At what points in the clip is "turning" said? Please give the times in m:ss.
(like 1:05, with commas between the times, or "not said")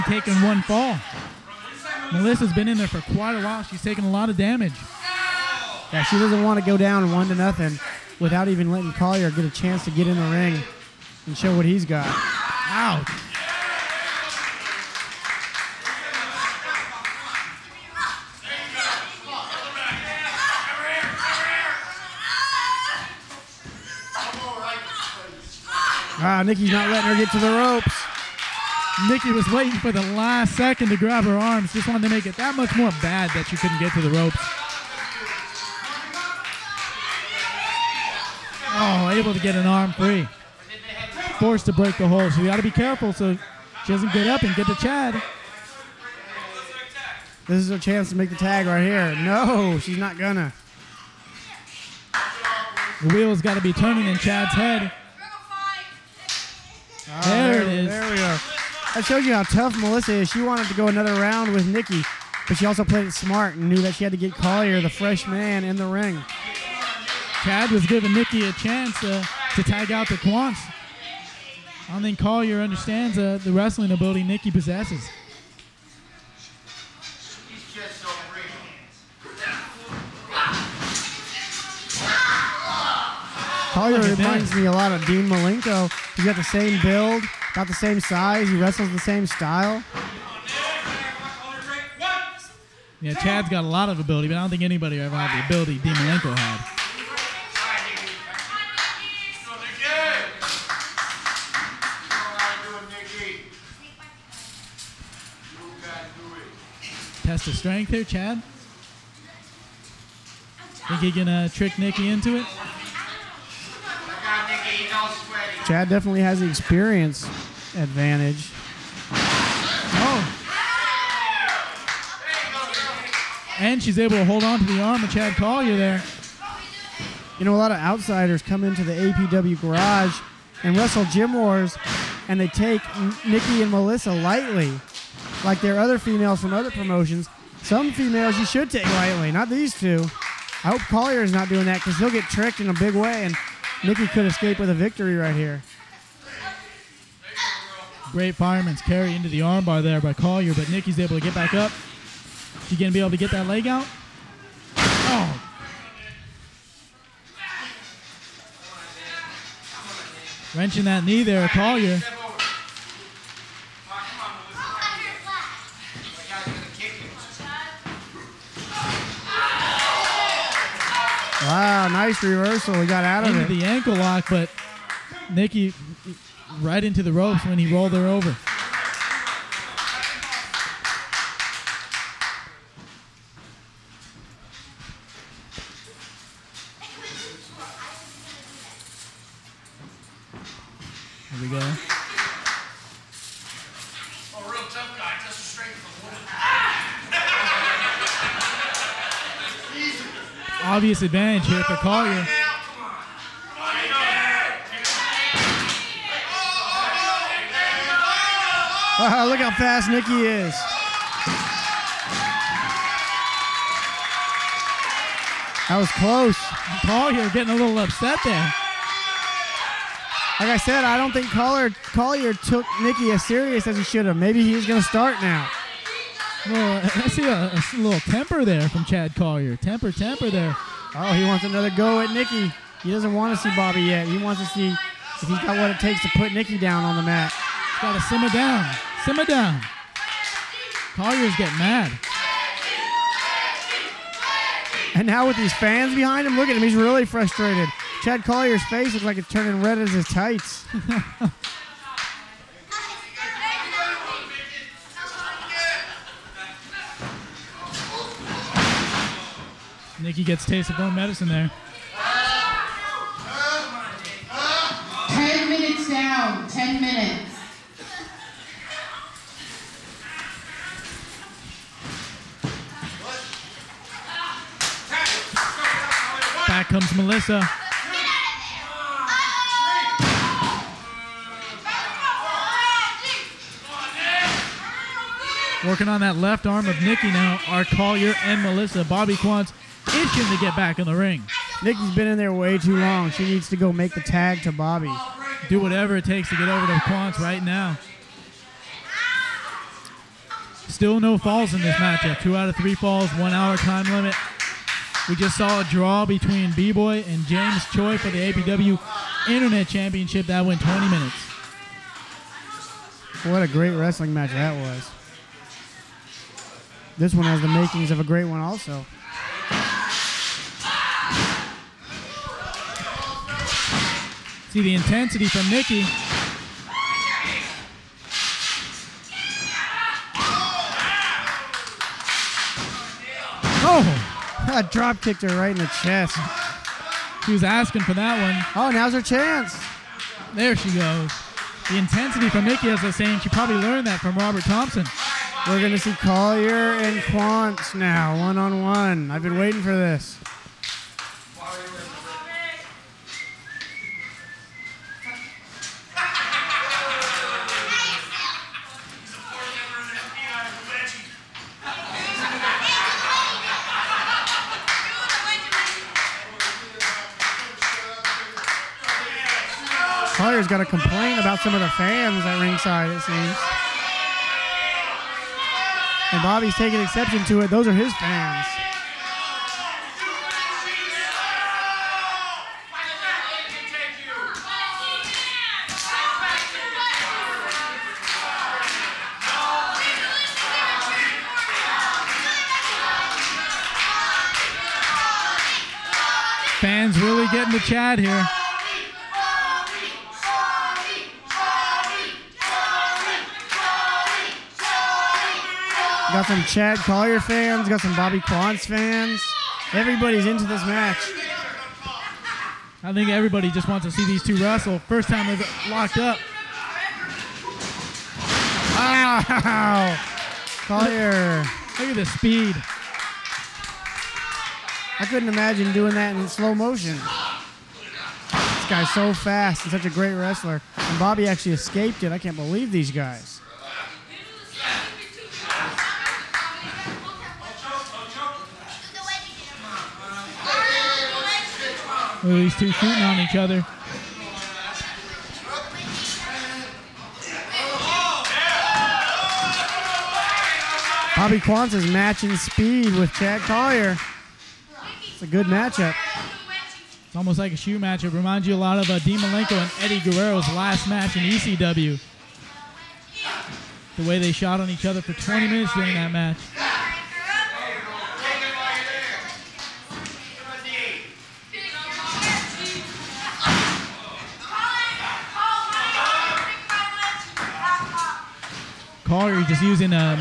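0:53, 4:09.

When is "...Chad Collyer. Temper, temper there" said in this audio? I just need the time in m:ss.
3:48.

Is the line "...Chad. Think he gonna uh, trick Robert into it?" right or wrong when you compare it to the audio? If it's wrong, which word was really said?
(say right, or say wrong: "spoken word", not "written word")
wrong: "Nikki", not "Robert".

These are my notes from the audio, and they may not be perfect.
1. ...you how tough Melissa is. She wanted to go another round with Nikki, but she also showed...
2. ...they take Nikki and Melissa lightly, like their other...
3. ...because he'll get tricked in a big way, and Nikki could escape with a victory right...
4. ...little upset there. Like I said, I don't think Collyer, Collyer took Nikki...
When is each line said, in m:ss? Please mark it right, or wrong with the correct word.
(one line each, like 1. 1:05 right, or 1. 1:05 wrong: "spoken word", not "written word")
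1. 0:59 wrong: "played", not "showed"
2. 2:12 right
3. 2:21 right
4. 3:37 right.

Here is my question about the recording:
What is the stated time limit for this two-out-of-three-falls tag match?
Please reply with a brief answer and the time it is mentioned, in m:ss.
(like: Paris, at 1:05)
one hour, at 5:03.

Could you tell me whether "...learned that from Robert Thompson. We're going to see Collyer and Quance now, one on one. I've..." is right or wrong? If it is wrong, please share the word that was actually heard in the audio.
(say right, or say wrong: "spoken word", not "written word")
right.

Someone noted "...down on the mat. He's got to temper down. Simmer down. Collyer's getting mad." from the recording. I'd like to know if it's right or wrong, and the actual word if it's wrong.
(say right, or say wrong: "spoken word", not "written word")
wrong: "simmer", not "temper".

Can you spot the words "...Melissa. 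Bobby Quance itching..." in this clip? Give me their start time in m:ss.
4:48.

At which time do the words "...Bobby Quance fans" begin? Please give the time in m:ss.
6:47.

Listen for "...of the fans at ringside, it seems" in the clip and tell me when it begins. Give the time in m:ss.
6:11.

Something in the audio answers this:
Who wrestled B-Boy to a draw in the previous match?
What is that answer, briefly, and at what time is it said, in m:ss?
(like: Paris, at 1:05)
James Choi, at 5:07.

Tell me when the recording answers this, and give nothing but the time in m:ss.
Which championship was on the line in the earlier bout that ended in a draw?
5:08.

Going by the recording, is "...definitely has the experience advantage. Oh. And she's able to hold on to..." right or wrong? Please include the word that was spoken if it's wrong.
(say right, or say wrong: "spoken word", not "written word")
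right.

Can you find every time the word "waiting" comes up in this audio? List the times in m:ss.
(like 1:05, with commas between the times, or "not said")
0:29, 5:49.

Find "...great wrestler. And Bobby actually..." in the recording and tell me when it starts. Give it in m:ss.
7:09.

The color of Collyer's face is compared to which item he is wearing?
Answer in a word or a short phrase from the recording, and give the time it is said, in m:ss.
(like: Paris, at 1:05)
his tights, at 4:10.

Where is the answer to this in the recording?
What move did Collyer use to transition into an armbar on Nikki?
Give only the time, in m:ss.
2:28.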